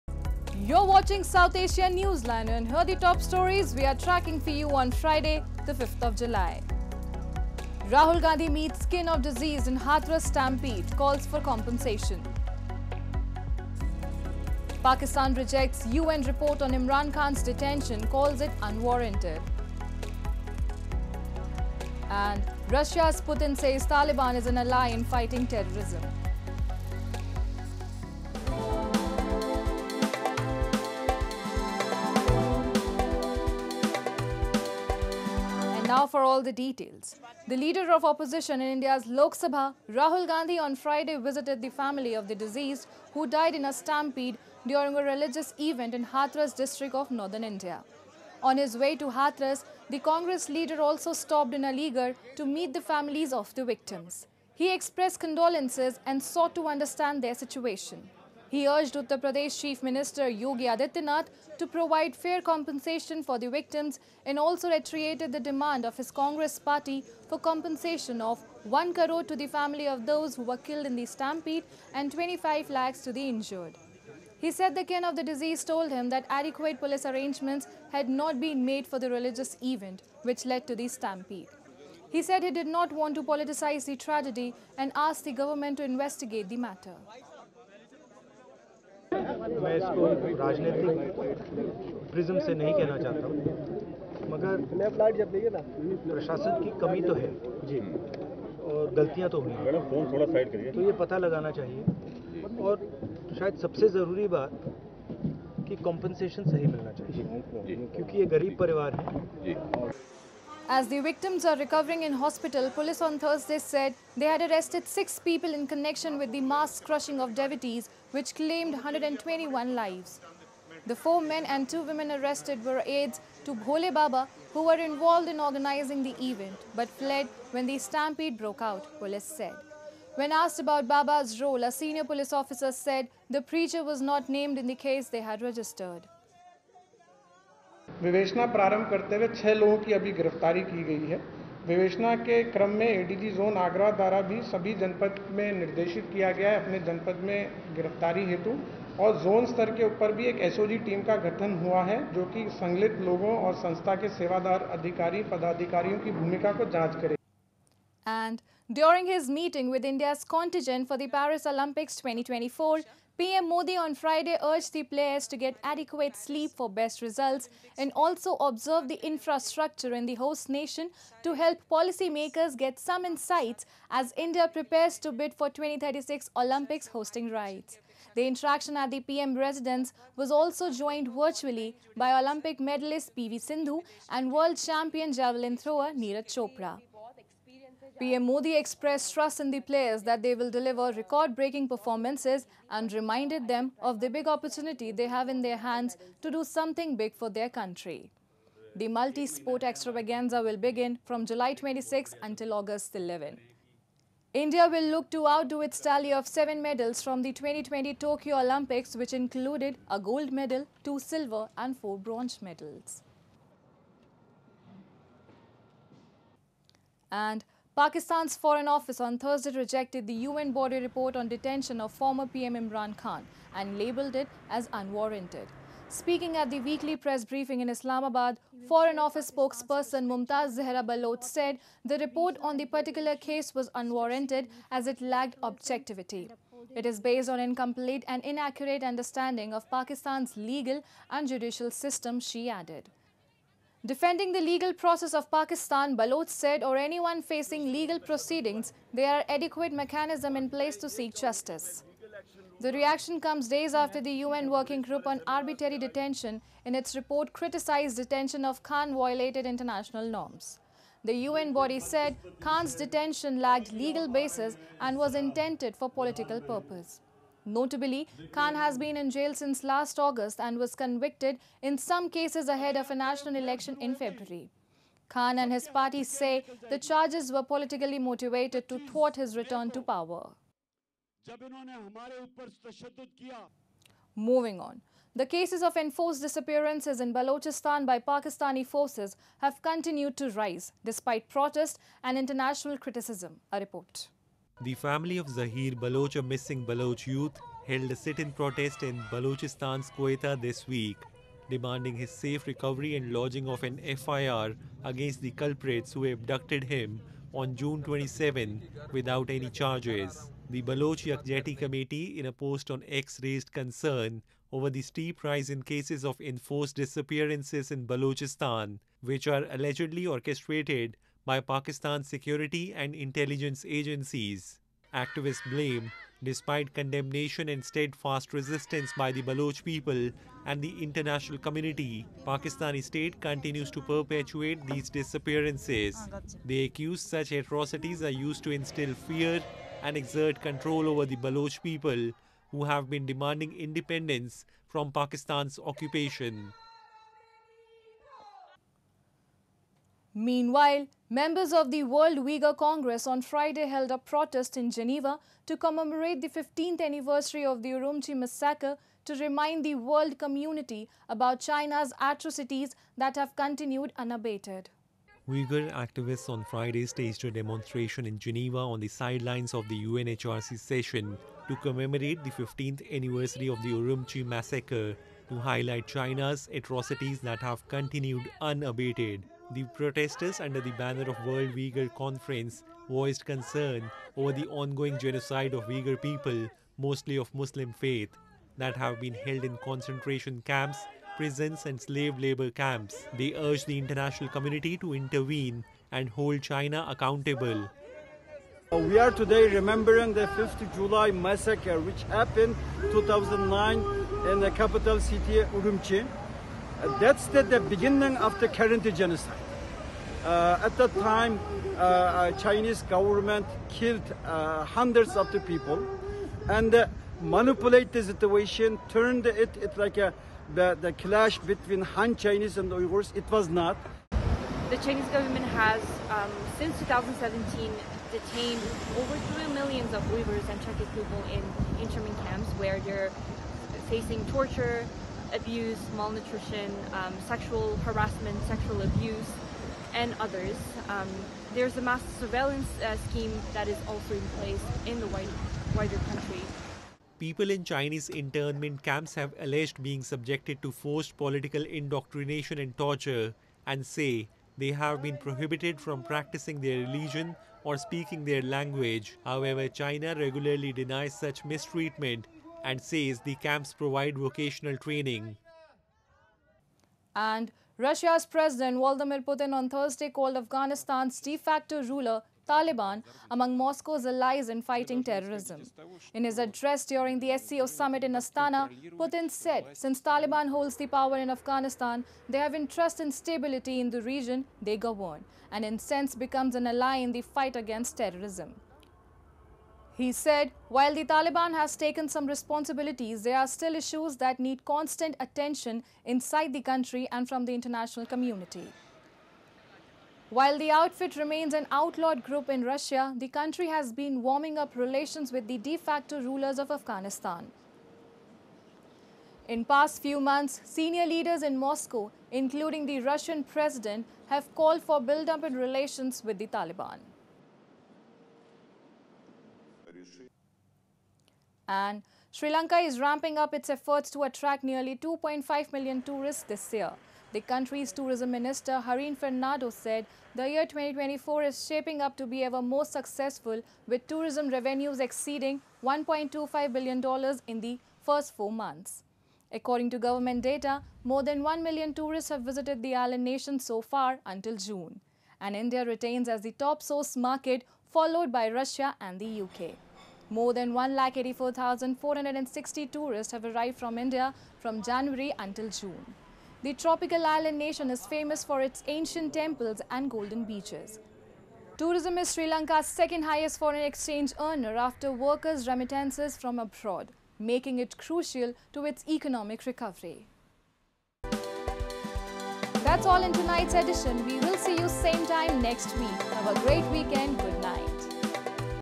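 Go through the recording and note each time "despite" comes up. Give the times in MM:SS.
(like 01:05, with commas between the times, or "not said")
04:50, 05:26.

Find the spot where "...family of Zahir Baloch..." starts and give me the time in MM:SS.
04:54.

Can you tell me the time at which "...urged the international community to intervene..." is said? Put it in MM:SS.
06:33.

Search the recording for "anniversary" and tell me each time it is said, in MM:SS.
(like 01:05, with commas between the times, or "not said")
05:56, 06:12.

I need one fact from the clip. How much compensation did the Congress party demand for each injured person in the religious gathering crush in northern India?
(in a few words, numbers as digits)
25 lakhs.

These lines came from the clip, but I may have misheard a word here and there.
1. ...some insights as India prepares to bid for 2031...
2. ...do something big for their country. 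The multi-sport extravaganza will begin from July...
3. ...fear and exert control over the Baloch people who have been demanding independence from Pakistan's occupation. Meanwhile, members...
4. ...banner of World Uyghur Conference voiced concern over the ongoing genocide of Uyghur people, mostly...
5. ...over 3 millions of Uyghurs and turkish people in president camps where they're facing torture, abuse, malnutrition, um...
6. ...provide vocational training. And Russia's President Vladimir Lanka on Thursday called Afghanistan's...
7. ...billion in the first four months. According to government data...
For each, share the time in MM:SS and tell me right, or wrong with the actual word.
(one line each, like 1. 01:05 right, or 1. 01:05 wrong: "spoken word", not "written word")
1. 02:52 wrong: "2036", not "2031"
2. 03:16 right
3. 05:39 right
4. 06:20 right
5. 07:08 wrong: "internment", not "president"
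6. 07:43 wrong: "Putin", not "Lanka"
7. 08:56 right.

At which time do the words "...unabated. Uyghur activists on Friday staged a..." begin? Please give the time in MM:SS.
06:03.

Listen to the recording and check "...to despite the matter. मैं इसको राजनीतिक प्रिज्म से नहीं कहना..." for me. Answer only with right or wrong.
wrong.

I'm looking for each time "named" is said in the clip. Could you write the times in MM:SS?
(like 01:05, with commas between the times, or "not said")
02:14.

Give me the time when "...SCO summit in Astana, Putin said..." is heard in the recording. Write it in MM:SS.
07:57.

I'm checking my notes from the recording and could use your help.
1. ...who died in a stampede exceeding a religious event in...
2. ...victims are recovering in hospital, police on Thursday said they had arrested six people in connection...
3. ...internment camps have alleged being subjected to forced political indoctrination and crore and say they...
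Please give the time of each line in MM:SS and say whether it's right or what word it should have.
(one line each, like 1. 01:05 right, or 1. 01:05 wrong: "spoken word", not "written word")
1. 00:43 wrong: "during", not "exceeding"
2. 01:51 right
3. 07:28 wrong: "torture", not "crore".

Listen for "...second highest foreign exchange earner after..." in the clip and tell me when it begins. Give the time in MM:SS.
09:22.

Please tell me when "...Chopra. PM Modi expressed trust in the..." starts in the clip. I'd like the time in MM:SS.
03:06.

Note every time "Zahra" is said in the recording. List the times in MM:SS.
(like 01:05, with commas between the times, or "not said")
03:50.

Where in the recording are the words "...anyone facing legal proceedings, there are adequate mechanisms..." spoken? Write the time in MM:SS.
04:06.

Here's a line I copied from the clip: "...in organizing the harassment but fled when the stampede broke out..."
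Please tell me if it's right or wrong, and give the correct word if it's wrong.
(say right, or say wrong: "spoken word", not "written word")
wrong: "event", not "harassment".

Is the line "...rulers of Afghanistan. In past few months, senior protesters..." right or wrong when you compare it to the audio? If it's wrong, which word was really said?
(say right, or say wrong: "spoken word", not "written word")
wrong: "leaders", not "protesters".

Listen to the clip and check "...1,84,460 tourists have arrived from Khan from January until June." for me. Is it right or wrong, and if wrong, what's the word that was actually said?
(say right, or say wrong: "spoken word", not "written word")
wrong: "India", not "Khan".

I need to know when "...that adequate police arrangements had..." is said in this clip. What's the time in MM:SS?
01:16.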